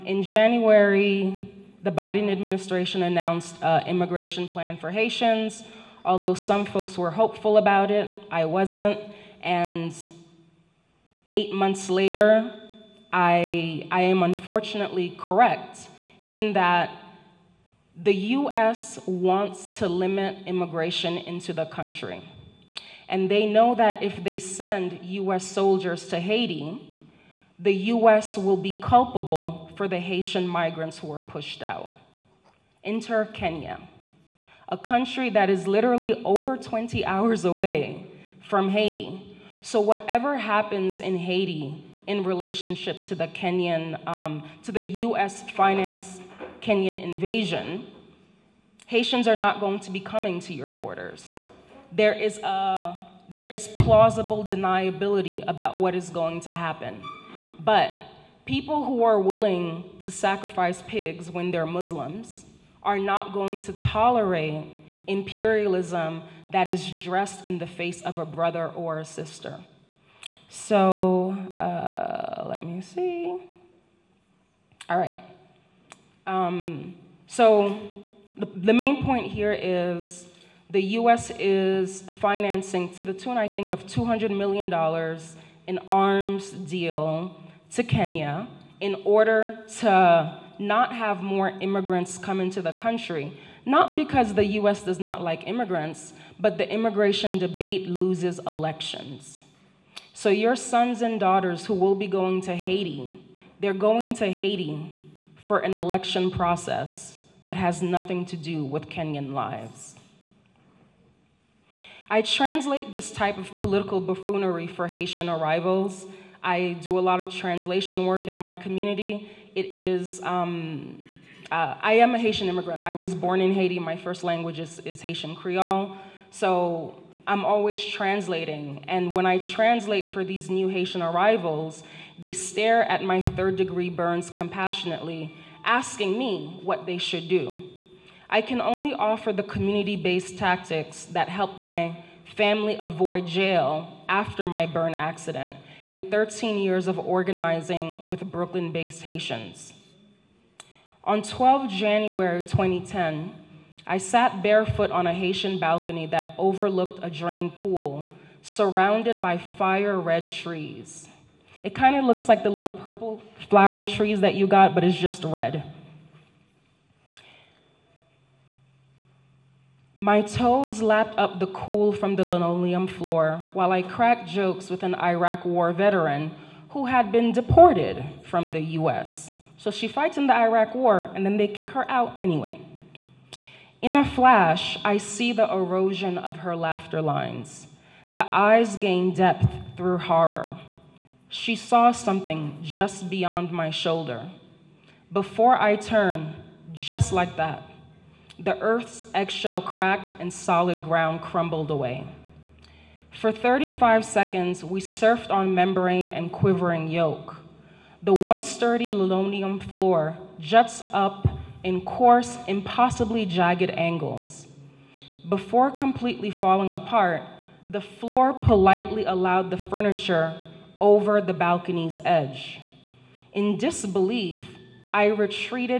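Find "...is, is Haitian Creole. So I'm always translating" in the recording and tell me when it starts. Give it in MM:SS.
02:04.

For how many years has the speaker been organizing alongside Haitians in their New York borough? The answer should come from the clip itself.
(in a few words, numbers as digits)
13.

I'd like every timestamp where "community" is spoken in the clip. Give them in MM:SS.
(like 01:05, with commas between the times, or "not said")
01:58, 02:19.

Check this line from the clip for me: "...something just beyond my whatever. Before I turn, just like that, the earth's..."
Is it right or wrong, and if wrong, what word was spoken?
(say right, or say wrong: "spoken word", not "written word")
wrong: "shoulder", not "whatever".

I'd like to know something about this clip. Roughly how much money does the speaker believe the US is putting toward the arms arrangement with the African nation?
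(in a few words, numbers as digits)
$200 million.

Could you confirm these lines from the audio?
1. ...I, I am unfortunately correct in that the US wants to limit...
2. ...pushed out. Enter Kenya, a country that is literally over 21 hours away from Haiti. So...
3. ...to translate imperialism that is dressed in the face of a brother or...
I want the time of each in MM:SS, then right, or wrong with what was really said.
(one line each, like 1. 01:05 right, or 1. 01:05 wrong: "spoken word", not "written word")
1. 00:13 right
2. 00:31 wrong: "20", not "21"
3. 01:03 wrong: "tolerate", not "translate".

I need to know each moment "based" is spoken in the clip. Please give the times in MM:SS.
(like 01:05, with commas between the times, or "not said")
02:19, 02:28.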